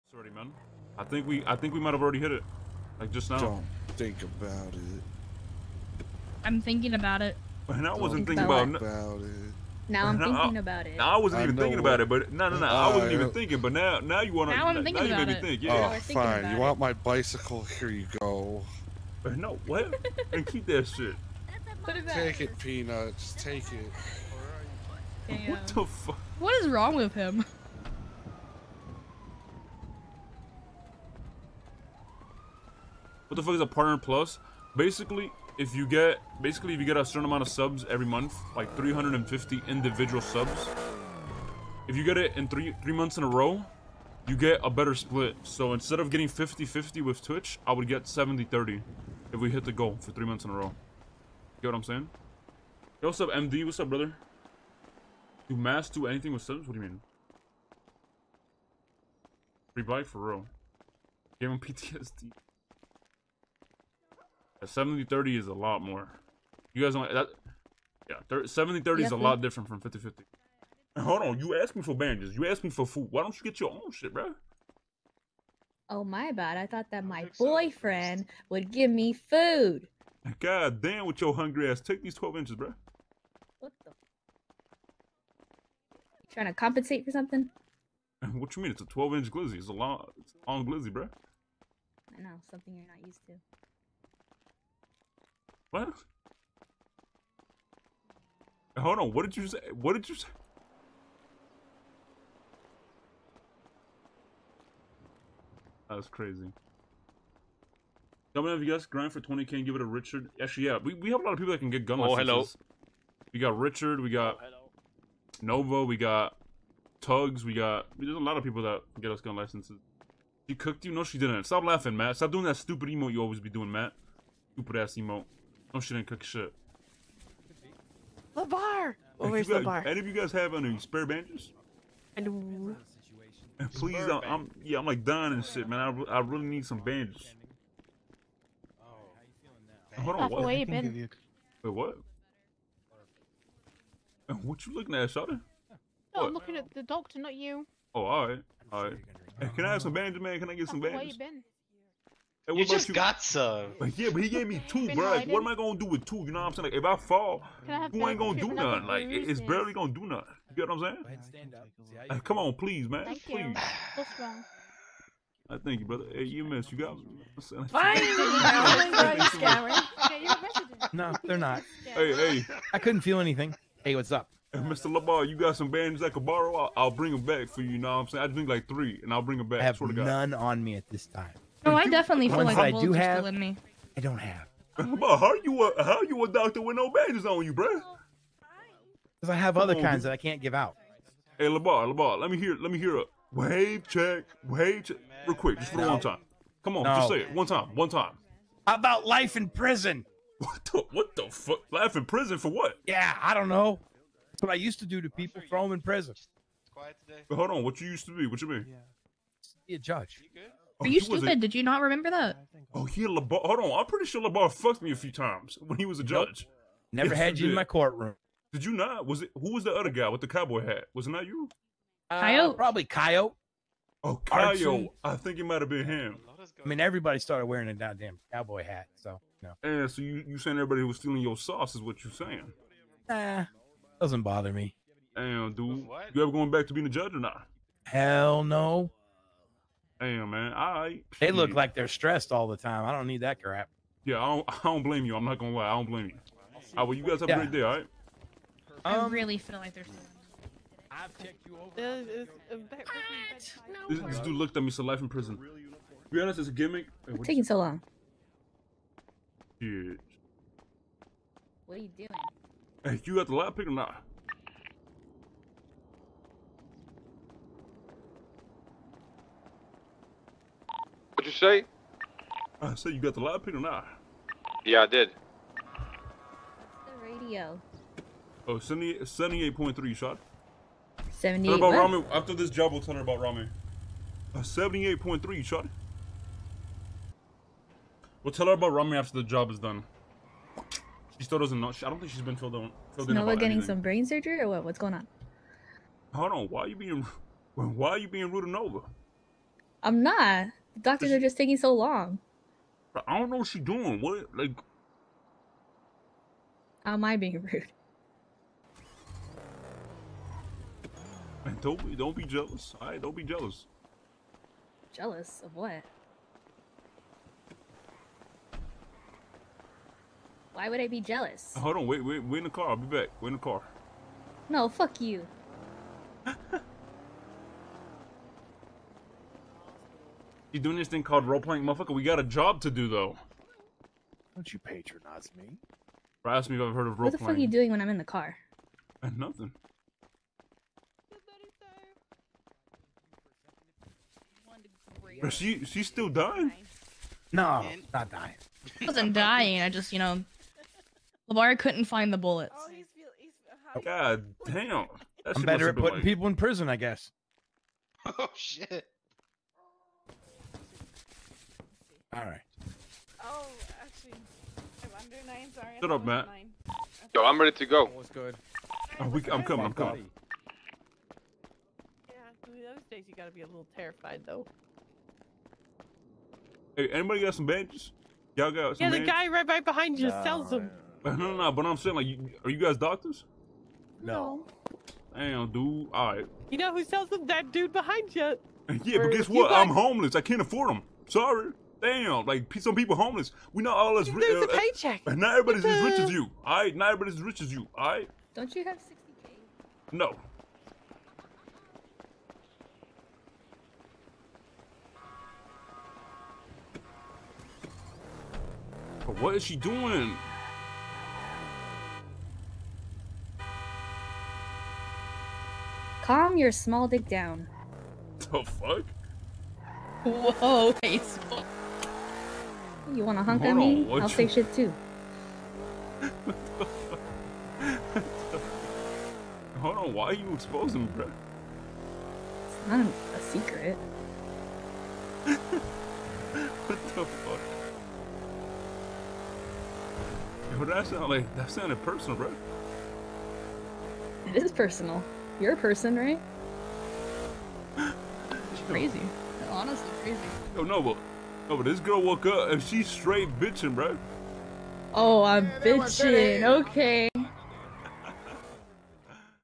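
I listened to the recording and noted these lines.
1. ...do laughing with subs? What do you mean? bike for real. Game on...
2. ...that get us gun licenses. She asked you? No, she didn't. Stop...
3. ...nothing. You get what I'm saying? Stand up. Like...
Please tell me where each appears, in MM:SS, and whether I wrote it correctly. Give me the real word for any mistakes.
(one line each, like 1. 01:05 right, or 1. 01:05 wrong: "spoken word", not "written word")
1. 00:55 wrong: "anything", not "laughing"
2. 01:58 wrong: "cooked", not "asked"
3. 02:40 right.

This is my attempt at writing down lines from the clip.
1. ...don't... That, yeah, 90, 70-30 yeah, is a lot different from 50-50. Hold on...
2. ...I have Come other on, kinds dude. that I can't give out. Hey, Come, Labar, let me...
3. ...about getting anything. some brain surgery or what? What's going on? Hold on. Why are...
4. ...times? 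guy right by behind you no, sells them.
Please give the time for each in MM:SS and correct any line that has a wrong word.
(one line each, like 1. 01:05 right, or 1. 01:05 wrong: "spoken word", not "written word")
1. 01:06 wrong: "30", not "90"
2. 03:09 wrong: "Labar", not "Come"
3. 04:53 right
4. 06:19 wrong: "bandages", not "times".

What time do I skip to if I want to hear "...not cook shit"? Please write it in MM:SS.
02:05.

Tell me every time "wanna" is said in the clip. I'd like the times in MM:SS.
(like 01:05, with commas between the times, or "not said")
07:03.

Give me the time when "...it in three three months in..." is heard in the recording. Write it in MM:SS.
00:42.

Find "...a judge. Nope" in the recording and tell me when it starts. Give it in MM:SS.
03:35.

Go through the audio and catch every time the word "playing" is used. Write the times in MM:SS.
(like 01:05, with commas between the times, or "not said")
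05:31, 05:36.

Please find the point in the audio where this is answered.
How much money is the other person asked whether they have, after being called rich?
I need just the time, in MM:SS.
06:38.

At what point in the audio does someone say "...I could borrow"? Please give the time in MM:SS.
02:56.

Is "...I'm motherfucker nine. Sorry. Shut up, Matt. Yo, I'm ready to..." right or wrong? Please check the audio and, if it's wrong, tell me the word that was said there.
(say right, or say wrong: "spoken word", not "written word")
wrong: "under", not "motherfucker".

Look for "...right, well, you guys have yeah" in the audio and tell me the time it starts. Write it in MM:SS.
04:06.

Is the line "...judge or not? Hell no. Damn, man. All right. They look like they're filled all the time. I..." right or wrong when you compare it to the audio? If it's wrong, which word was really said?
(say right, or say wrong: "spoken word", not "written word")
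wrong: "stressed", not "filled".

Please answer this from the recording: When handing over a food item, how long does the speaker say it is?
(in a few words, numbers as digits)
12 inches.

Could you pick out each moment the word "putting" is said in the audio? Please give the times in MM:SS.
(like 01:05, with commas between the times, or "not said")
05:55.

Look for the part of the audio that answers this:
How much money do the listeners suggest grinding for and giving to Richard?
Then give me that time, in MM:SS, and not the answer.
01:48.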